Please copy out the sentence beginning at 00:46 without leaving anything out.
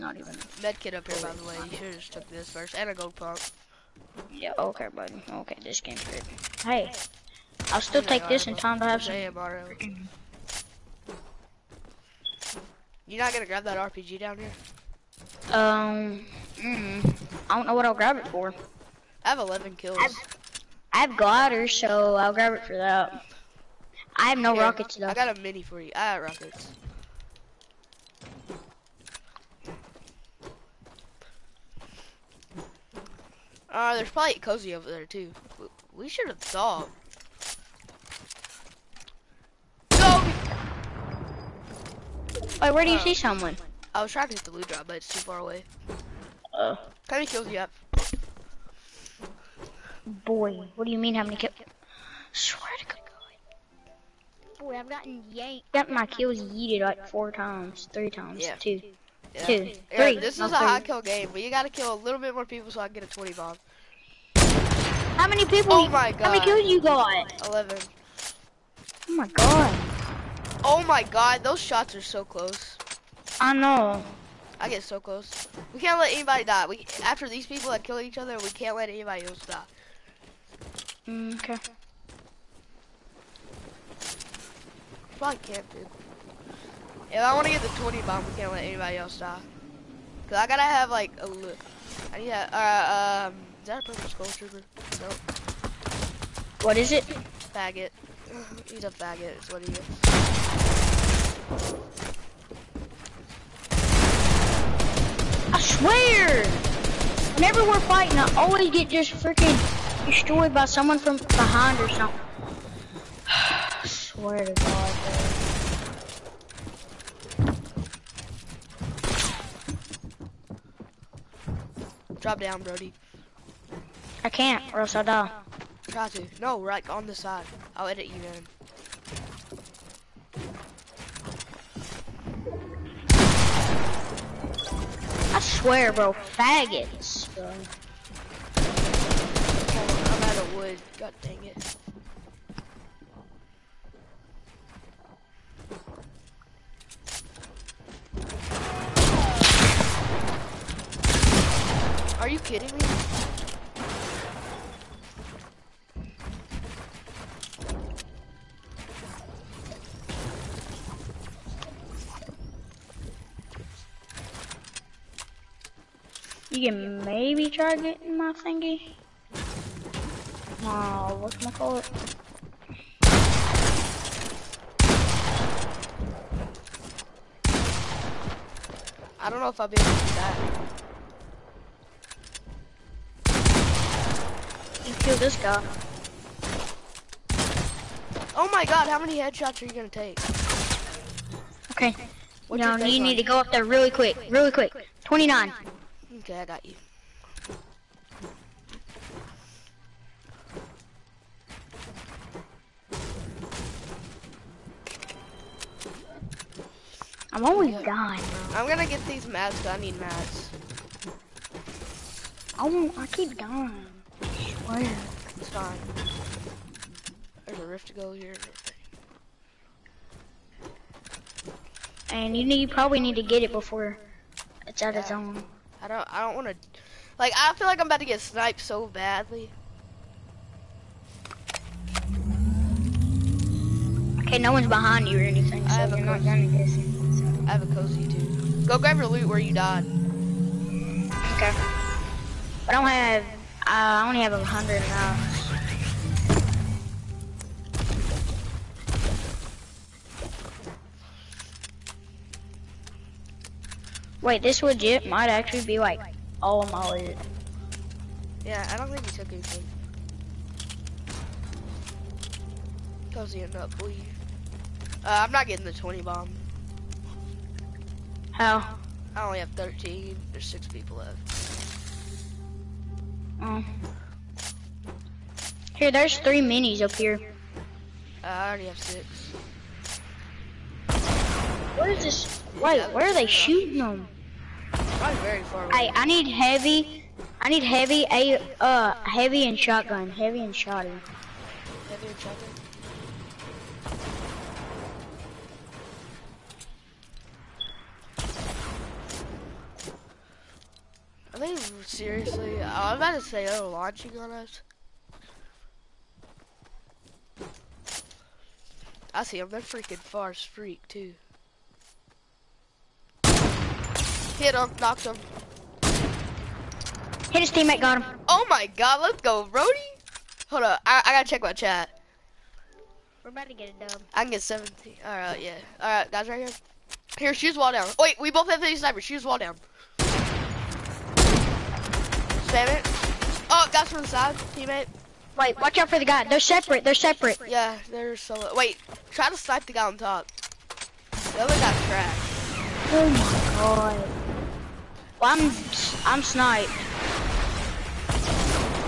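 Uh, how many kills do you have?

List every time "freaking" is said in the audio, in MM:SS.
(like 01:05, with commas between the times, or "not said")
01:49, 05:09.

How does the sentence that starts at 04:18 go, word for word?
Yeah, I don't think he took anything.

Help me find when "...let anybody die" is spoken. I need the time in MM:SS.
01:15.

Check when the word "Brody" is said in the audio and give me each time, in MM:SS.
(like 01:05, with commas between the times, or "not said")
02:02.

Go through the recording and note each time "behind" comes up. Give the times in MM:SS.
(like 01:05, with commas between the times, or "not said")
01:51, 03:54.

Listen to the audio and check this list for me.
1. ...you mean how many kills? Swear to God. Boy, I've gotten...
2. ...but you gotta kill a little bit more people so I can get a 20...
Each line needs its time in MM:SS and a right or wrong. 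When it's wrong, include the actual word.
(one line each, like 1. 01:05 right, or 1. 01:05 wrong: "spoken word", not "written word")
1. 00:50 right
2. 01:01 right.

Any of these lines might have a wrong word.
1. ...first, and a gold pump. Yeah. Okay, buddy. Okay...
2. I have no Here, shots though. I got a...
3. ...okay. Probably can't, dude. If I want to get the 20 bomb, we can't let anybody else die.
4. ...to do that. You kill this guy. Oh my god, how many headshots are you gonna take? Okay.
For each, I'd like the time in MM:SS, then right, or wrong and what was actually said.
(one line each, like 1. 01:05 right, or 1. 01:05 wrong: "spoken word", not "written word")
1. 00:02 right
2. 00:24 wrong: "rockets", not "shots"
3. 01:21 right
4. 02:59 right.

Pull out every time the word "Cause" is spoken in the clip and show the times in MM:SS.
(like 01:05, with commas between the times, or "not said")
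01:30, 04:23.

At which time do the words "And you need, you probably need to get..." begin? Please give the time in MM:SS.
03:42.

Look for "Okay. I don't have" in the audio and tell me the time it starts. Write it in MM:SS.
04:01.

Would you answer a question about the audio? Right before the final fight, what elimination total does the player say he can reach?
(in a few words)
17.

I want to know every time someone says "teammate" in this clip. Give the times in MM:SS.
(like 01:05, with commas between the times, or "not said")
05:17, 05:34.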